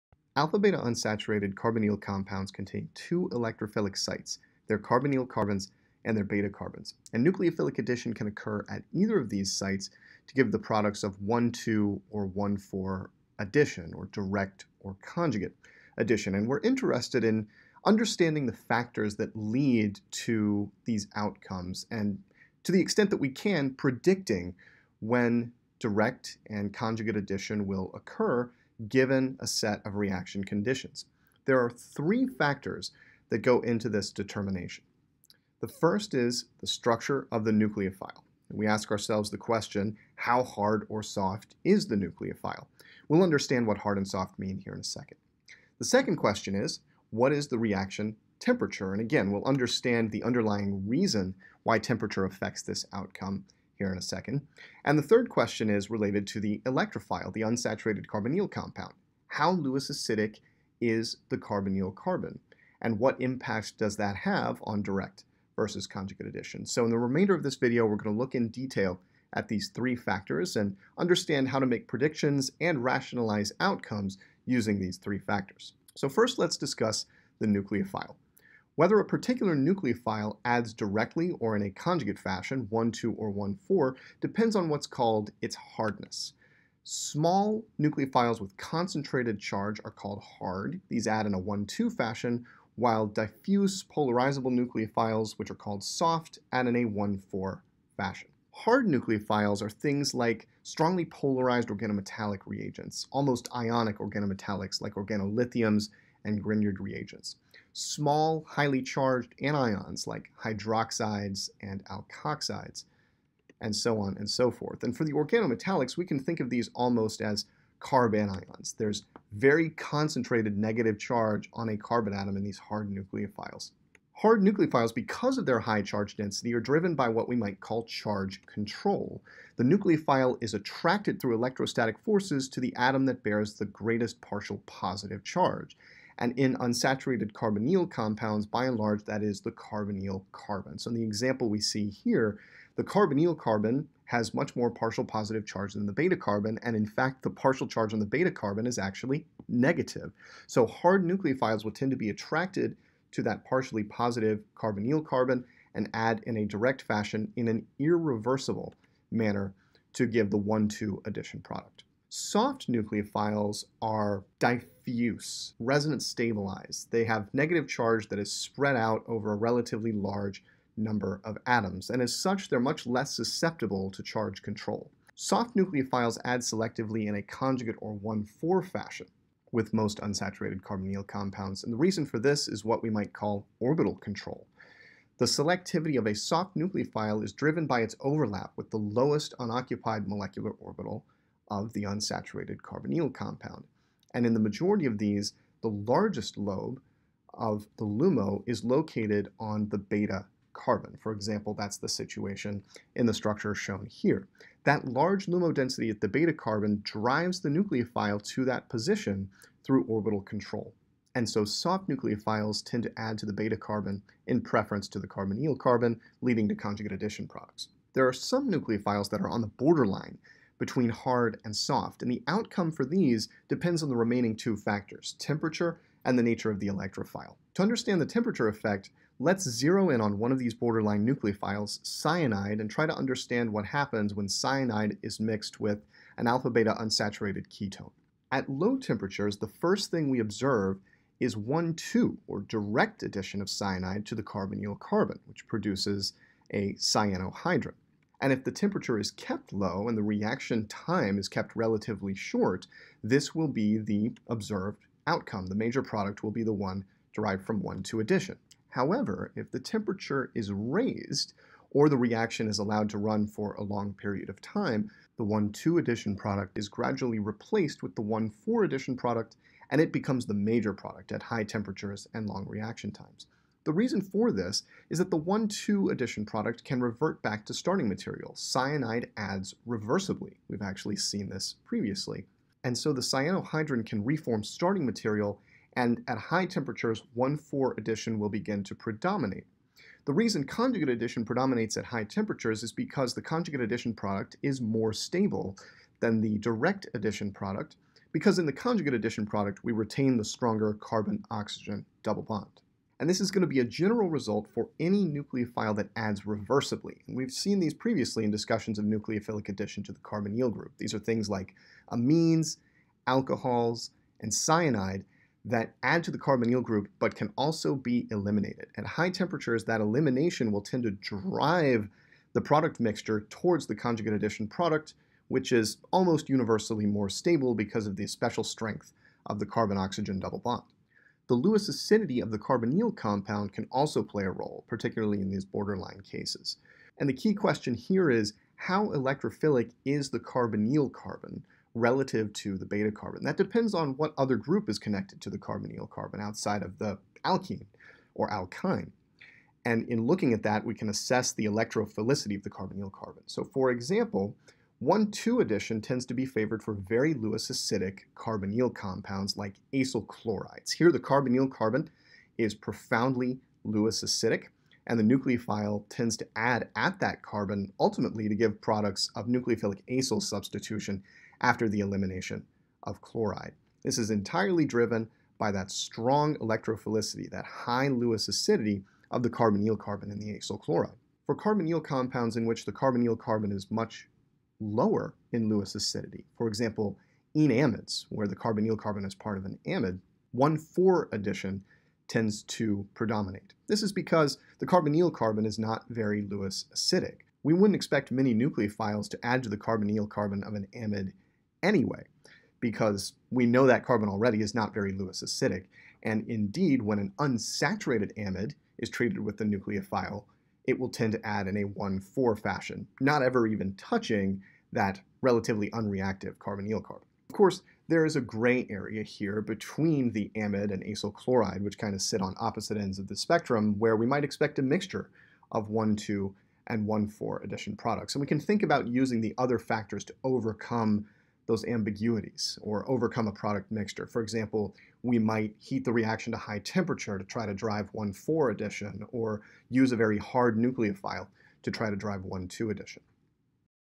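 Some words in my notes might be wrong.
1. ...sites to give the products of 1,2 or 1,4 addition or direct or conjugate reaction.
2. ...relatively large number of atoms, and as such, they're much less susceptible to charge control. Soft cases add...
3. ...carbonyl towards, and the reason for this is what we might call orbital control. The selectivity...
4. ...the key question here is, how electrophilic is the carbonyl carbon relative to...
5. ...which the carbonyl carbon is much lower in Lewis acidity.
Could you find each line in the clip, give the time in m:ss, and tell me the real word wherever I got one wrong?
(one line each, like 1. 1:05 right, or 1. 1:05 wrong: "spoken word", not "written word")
1. 0:09 wrong: "addition", not "reaction"
2. 2:49 wrong: "nucleophiles", not "cases"
3. 3:00 wrong: "compounds", not "towards"
4. 5:37 right
5. 6:22 right.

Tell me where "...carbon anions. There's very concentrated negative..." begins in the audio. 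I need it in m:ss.
1:57.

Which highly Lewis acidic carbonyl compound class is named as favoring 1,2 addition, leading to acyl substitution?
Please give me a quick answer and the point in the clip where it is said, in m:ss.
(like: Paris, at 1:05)
acyl chlorides, at 5:59.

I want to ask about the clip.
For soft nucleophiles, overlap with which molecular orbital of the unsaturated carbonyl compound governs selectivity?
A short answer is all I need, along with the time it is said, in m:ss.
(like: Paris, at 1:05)
lowest unoccupied molecular orbital, at 3:08.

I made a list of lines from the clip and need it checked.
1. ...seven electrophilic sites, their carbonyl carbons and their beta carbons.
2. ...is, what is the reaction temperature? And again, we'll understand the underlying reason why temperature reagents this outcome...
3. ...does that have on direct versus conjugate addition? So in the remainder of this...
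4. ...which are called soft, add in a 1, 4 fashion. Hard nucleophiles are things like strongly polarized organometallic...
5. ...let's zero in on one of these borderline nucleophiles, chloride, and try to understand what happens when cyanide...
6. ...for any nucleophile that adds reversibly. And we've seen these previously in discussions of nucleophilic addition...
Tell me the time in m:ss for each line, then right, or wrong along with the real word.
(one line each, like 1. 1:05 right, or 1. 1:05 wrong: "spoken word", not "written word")
1. 0:02 wrong: "two", not "seven"
2. 0:46 wrong: "affects", not "reagents"
3. 1:03 right
4. 1:35 right
5. 3:49 wrong: "cyanide", not "chloride"
6. 5:04 right.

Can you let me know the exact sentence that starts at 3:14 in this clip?
And in the majority of these, the largest lobe of the LUMO is located on the beta carbon.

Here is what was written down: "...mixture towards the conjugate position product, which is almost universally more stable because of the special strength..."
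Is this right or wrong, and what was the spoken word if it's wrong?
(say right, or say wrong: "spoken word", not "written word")
wrong: "addition", not "position".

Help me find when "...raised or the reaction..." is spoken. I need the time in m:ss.
4:20.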